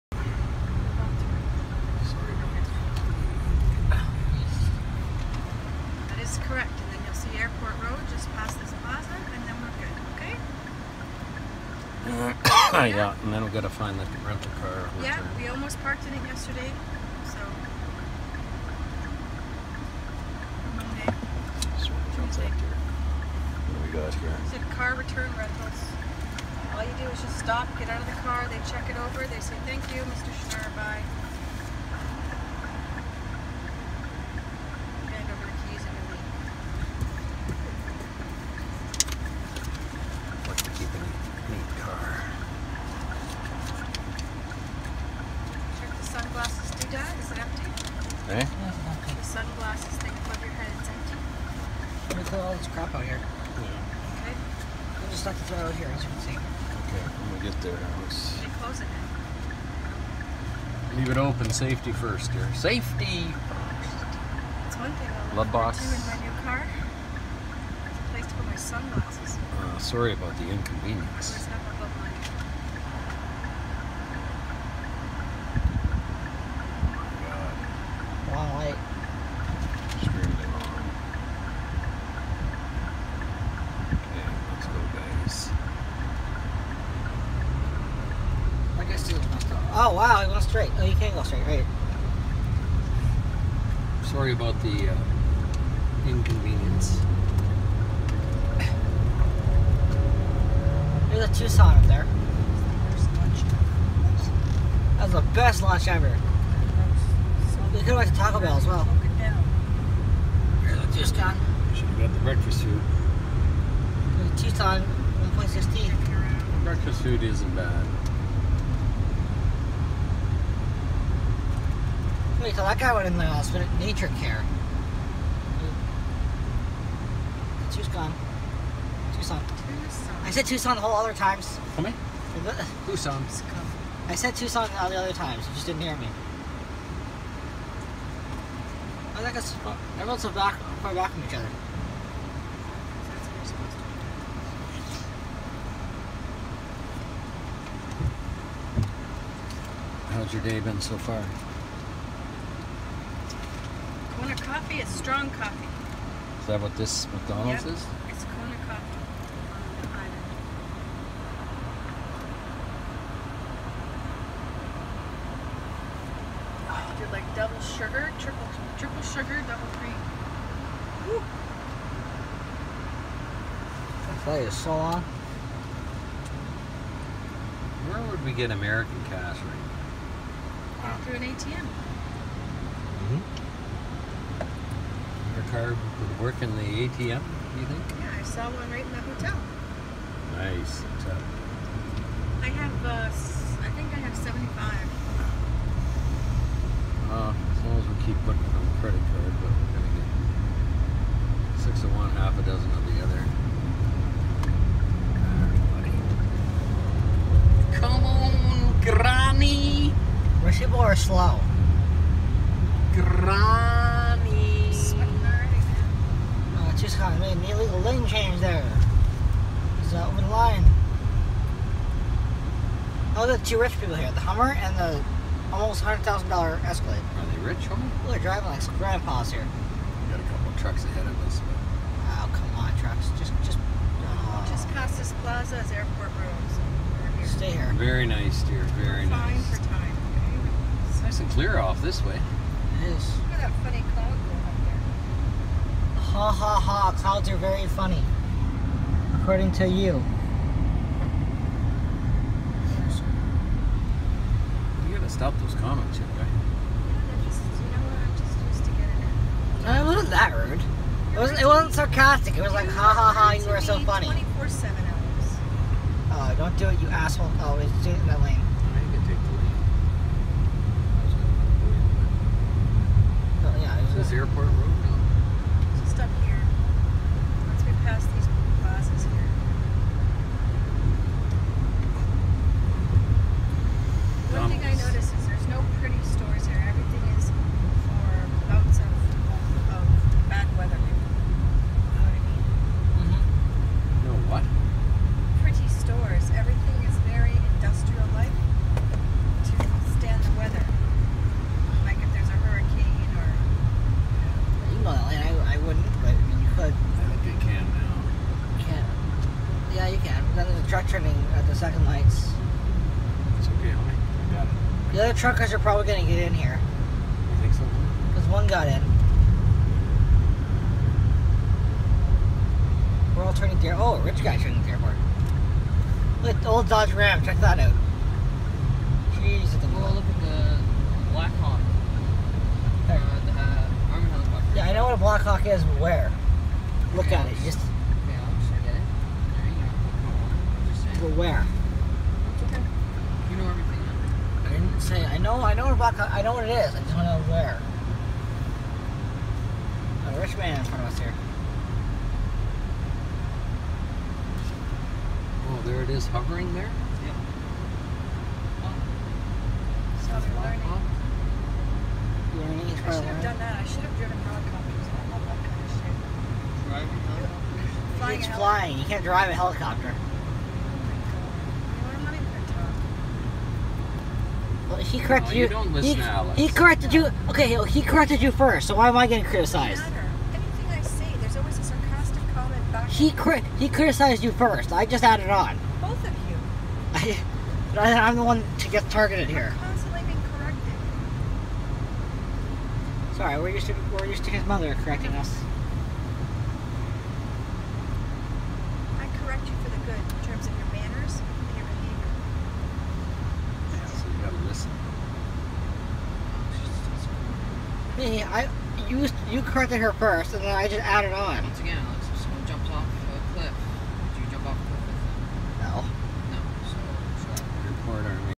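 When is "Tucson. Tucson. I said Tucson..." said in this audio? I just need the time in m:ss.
2:09.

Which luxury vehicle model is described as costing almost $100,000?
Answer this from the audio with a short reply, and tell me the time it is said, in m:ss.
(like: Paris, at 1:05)
Escalade, at 3:46.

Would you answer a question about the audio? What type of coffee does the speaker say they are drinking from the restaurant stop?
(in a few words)
Kona coffee.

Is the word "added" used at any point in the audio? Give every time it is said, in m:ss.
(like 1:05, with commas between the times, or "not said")
6:25, 6:50.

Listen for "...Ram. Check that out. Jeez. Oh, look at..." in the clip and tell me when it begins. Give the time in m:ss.
5:26.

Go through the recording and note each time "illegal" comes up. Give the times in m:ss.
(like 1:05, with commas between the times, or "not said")
3:37.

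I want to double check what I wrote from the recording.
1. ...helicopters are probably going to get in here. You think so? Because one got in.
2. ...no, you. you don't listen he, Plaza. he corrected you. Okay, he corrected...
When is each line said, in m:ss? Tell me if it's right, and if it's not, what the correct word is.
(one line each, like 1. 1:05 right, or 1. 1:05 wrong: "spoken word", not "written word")
1. 5:15 wrong: "truckers", not "helicopters"
2. 6:15 wrong: "Alex", not "Plaza".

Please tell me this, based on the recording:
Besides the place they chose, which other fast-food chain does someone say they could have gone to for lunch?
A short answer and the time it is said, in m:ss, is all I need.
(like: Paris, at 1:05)
Taco Bell, at 1:48.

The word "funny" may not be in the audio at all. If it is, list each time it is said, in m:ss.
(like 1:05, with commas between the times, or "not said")
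4:03, 4:07, 4:23.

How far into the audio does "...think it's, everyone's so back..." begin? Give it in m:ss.
2:19.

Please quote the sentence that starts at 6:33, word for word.
Sorry, we're used to we're used to his mother correcting us.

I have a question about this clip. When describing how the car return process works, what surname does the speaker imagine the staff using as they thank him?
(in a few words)
Schnurr.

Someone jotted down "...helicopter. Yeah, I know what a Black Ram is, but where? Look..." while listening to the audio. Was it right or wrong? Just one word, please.
wrong.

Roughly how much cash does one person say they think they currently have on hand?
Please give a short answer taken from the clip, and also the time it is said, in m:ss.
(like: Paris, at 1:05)
75, at 3:14.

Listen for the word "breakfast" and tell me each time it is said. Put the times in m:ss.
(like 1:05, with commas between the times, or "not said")
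1:52, 1:56.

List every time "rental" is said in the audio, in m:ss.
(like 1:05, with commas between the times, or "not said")
0:14, 0:25.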